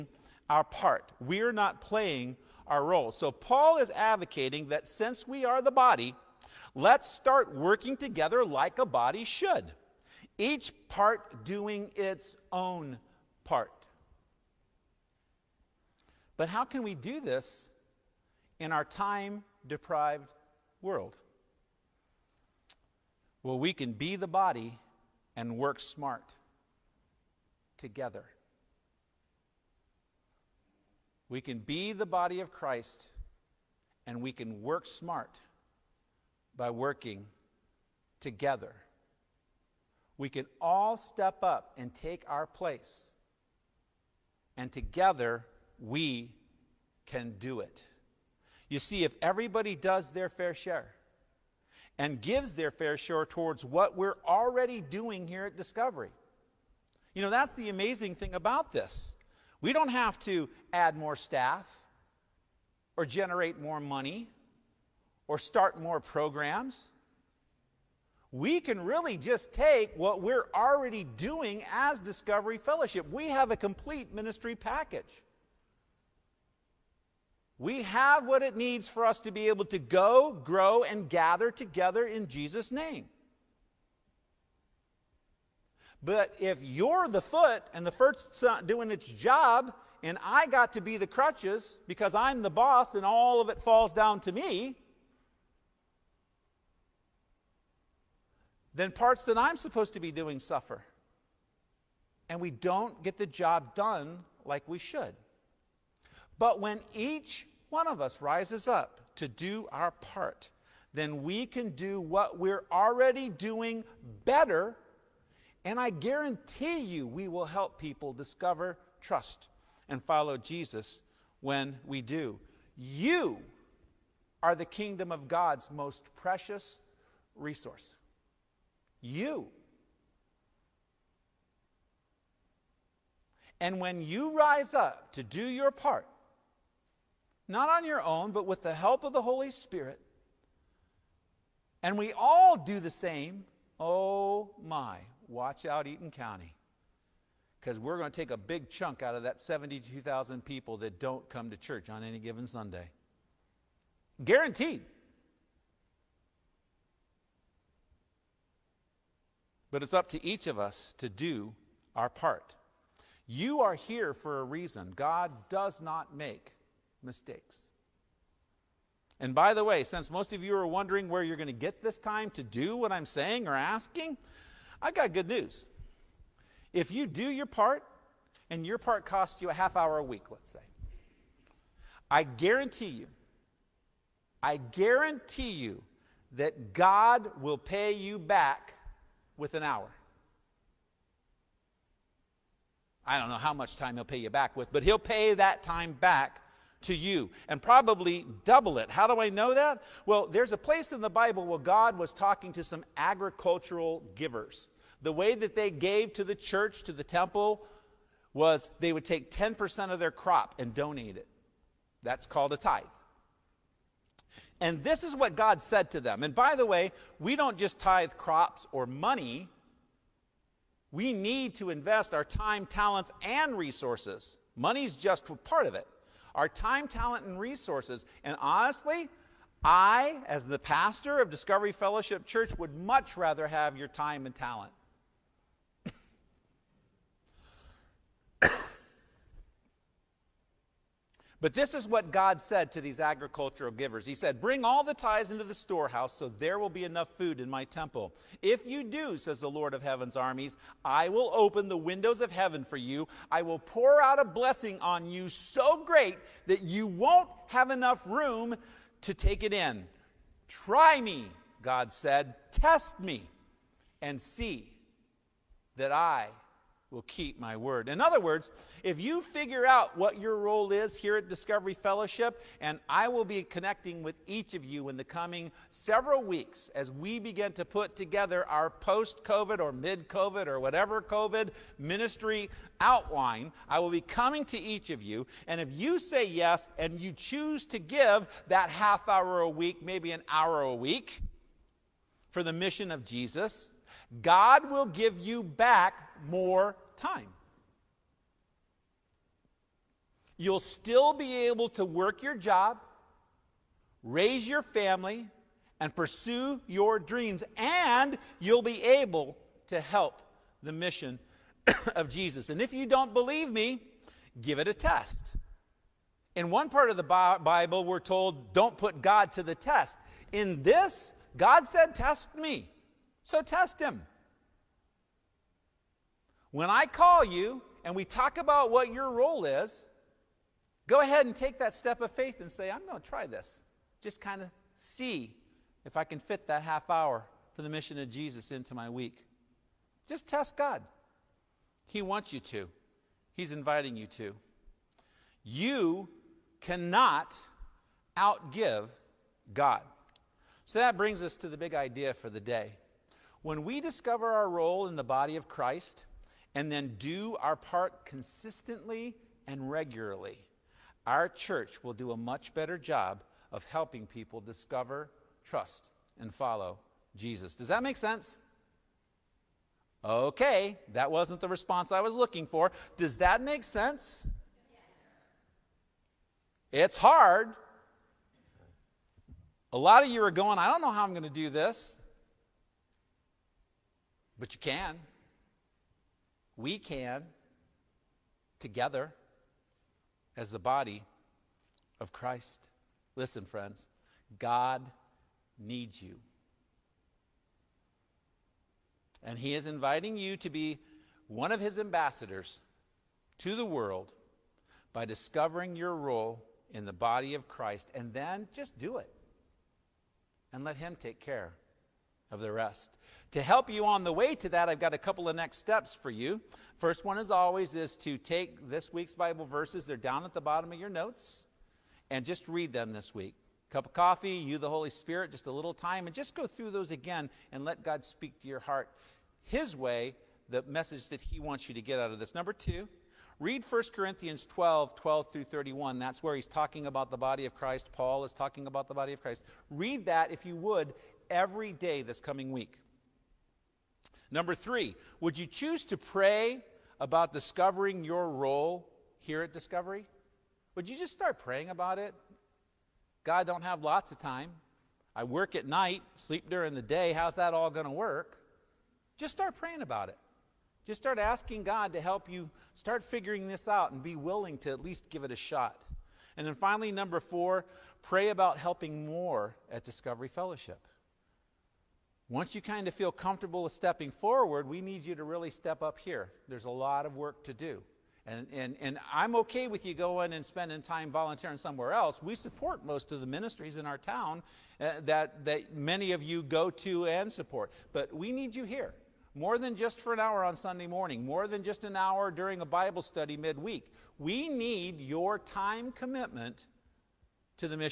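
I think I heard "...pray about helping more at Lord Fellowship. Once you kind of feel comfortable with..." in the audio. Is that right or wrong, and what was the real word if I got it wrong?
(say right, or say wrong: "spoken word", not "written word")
wrong: "Discovery", not "Lord".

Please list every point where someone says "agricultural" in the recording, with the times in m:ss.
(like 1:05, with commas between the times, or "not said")
3:22, 4:02.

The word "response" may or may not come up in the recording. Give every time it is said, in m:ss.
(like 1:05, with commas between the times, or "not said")
6:11.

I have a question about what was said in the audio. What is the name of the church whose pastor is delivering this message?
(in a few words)
Discovery Fellowship Church.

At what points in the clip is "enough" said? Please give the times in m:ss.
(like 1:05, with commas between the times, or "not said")
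4:06, 4:17.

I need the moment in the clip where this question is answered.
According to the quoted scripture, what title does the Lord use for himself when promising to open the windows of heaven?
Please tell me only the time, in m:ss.
4:09.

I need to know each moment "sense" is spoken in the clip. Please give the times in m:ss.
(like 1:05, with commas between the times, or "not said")
6:07, 6:13.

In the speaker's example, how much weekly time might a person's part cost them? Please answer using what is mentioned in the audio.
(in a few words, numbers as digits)
A half hour.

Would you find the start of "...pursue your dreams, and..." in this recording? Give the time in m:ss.
5:05.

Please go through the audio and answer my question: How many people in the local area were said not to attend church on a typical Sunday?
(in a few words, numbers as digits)
72,000.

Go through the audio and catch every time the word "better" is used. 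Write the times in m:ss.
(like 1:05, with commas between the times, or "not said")
1:54, 6:02.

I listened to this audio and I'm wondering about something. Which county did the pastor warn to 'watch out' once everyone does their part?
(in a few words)
Eaton County.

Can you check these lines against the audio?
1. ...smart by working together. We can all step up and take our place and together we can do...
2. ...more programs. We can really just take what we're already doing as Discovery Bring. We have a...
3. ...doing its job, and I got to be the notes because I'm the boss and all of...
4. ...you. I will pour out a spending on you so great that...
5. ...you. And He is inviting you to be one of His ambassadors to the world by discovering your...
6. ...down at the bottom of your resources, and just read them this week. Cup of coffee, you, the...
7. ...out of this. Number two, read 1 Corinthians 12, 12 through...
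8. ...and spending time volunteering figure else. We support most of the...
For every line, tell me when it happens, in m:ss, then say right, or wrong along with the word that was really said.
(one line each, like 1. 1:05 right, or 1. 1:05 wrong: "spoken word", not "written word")
1. 0:34 right
2. 1:05 wrong: "Fellowship", not "Bring"
3. 1:28 wrong: "crutches", not "notes"
4. 4:12 wrong: "blessing", not "spending"
5. 6:36 right
6. 6:59 wrong: "notes", not "resources"
7. 7:11 right
8. 8:00 wrong: "somewhere", not "figure".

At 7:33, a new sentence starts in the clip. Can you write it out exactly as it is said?
God, don't have lots of time.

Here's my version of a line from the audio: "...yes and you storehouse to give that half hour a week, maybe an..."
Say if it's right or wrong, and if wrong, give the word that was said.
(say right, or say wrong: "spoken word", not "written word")
wrong: "choose", not "storehouse".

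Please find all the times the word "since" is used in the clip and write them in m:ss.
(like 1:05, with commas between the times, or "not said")
0:04, 2:49.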